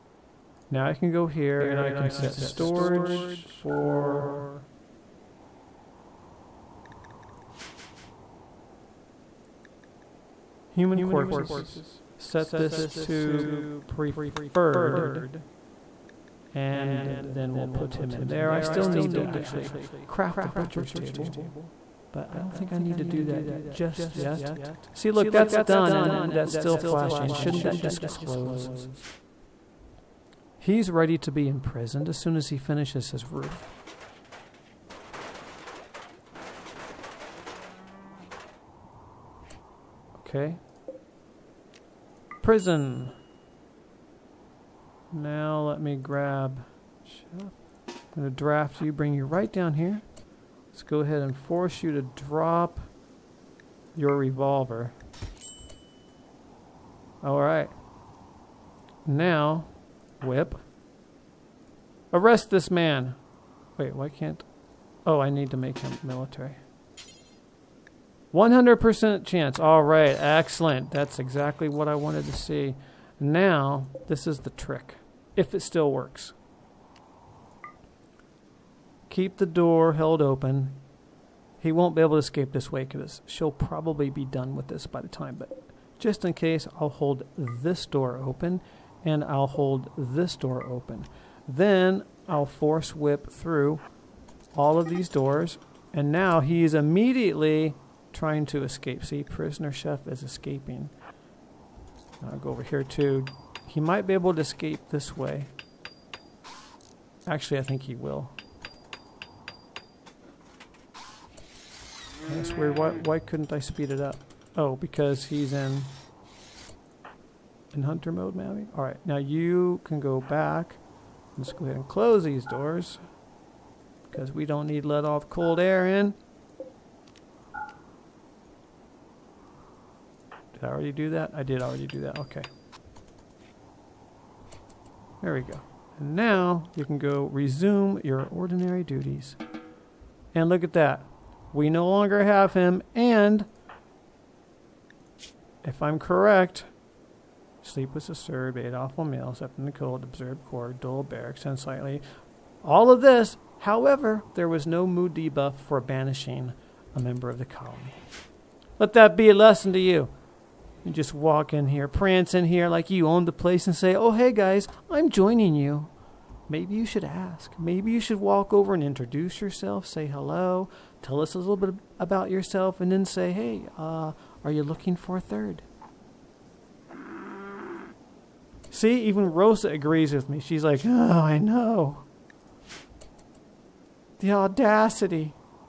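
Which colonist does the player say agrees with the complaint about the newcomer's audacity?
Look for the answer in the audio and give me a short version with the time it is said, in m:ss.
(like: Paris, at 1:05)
Rosa, at 2:59.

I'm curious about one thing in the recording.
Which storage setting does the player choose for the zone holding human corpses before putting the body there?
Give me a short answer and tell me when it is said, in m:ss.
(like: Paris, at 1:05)
Preferred, at 0:13.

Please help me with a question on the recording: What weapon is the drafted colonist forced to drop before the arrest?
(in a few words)
Revolver.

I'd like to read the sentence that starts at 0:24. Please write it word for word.
See, look, that's done and that's still flashing.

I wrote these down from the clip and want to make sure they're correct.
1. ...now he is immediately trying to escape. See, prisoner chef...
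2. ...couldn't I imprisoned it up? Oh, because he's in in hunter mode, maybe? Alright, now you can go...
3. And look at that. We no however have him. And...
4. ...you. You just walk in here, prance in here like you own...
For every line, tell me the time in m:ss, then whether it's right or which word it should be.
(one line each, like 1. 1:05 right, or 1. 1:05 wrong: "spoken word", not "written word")
1. 1:36 right
2. 1:53 wrong: "speed", not "imprisoned"
3. 2:20 wrong: "longer", not "however"
4. 2:39 right.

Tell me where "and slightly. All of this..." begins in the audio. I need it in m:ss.
2:31.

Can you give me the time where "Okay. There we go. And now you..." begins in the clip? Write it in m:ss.
2:12.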